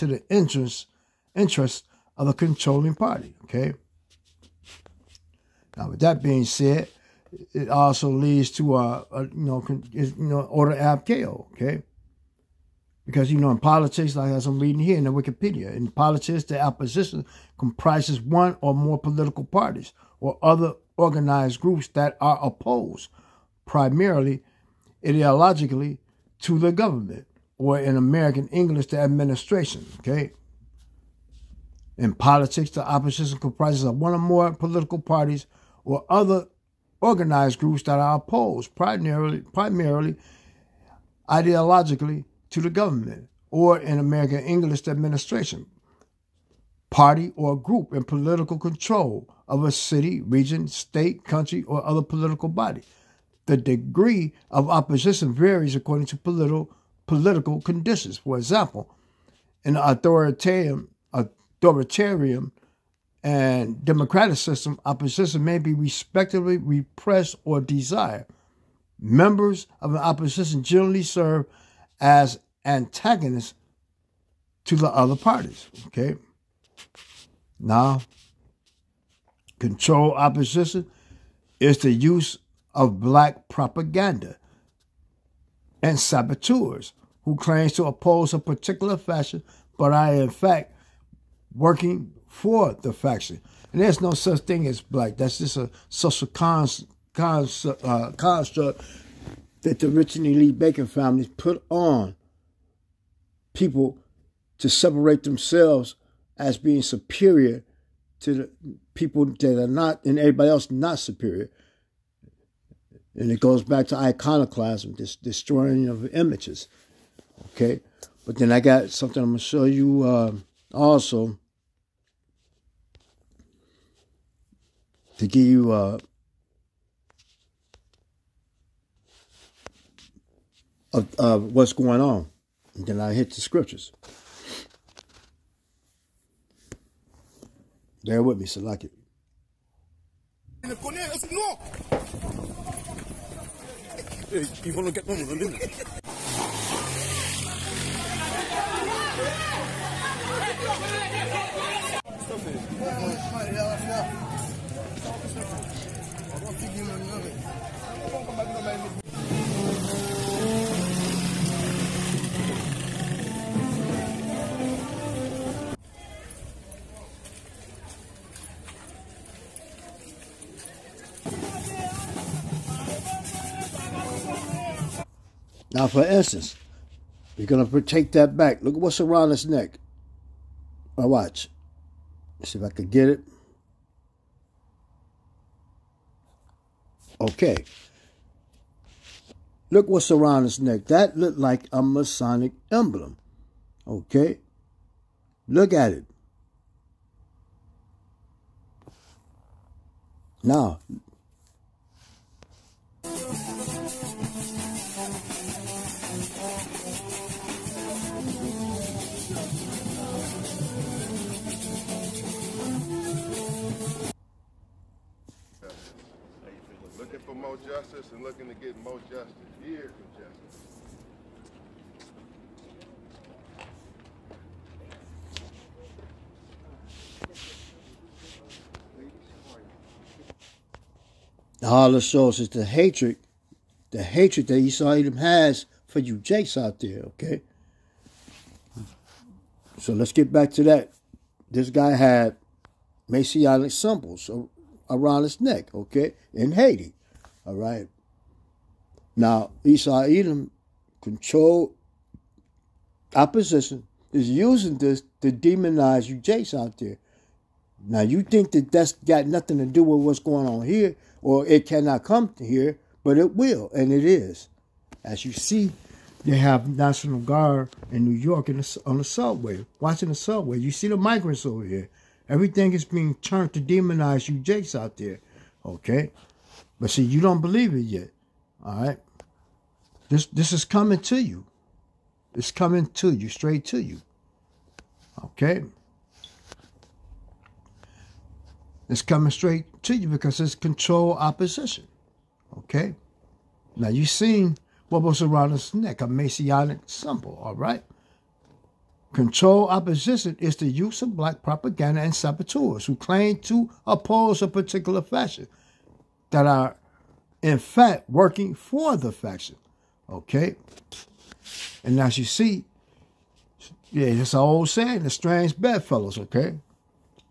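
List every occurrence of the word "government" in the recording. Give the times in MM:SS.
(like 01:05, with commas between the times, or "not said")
00:26, 00:42.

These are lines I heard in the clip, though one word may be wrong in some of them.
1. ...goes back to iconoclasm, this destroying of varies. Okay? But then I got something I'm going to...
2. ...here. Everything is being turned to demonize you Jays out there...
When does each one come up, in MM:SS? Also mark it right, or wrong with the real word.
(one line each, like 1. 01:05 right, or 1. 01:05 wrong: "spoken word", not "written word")
1. 01:53 wrong: "images", not "varies"
2. 04:31 right.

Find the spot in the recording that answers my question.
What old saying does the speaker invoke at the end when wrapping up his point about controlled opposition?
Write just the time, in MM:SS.
05:15.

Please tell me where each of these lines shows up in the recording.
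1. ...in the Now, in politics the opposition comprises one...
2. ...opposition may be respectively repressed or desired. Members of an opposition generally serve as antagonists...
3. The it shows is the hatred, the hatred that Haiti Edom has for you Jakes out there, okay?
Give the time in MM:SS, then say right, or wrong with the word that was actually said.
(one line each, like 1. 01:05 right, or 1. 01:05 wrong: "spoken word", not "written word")
1. 00:14 wrong: "Wikipedia", not "Now"
2. 01:04 right
3. 03:51 wrong: "Esau", not "Haiti".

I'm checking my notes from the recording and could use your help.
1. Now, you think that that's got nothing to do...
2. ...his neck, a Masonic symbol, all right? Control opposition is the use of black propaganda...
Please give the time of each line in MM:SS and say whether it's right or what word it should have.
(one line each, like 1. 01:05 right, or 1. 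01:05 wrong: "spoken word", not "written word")
1. 04:17 right
2. 04:55 right.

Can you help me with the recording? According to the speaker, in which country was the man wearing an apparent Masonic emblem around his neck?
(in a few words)
Haiti.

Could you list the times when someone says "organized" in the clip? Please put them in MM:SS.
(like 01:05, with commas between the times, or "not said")
00:20, 00:36.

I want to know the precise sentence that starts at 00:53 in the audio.
The degree of opposition varies according to political political conditions.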